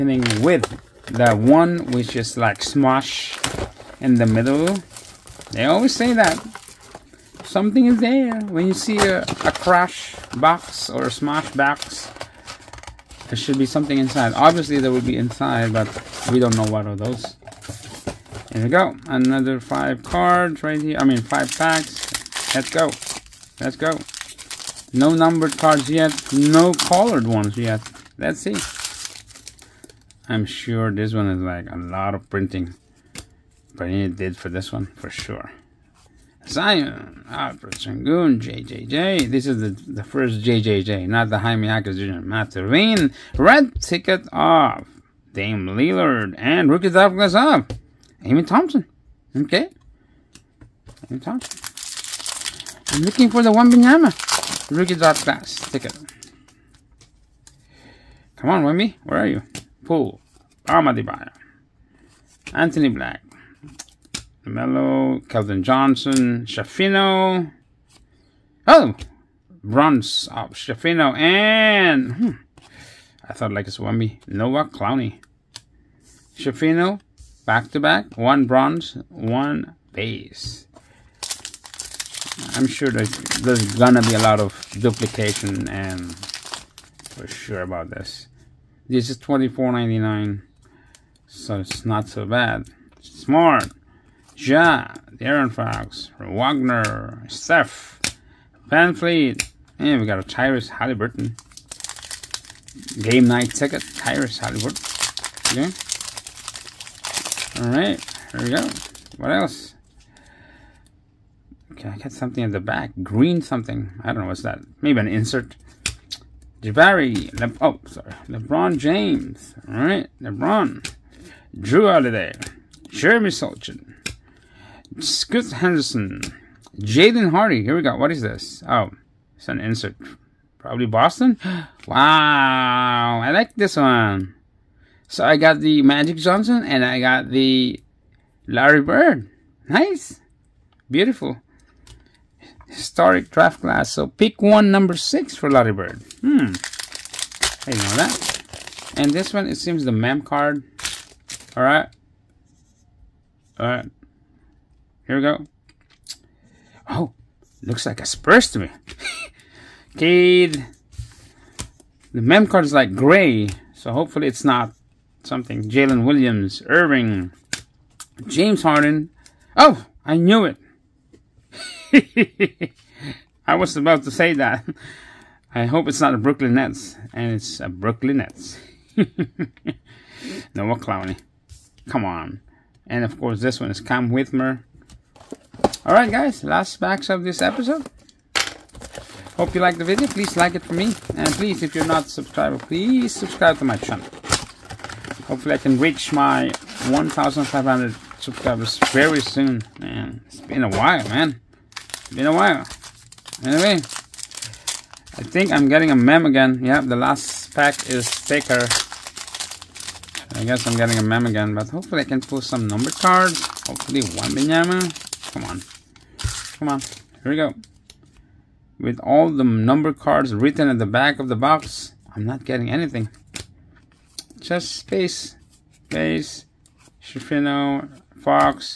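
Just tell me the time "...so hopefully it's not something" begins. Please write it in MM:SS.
02:43.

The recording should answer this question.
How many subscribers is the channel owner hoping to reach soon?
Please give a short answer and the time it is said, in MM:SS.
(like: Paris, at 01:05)
1,500, at 03:16.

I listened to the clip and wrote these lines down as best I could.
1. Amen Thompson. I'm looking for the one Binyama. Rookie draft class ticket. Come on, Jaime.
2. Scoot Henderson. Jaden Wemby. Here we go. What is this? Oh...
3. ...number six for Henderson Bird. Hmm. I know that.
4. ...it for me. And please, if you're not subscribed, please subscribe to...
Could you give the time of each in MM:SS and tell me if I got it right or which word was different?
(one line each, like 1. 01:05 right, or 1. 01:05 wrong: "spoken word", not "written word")
1. 00:51 wrong: "Wemby", not "Jaime"
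2. 02:05 wrong: "Hardy", not "Wemby"
3. 02:24 wrong: "Larry", not "Henderson"
4. 03:10 right.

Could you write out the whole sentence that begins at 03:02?
And of course, this one is Cam Whitmore.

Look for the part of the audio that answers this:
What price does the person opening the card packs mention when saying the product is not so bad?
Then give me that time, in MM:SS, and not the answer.
01:29.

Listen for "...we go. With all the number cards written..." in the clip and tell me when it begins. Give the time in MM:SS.
03:37.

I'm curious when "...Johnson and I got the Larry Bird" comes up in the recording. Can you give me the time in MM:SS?
02:16.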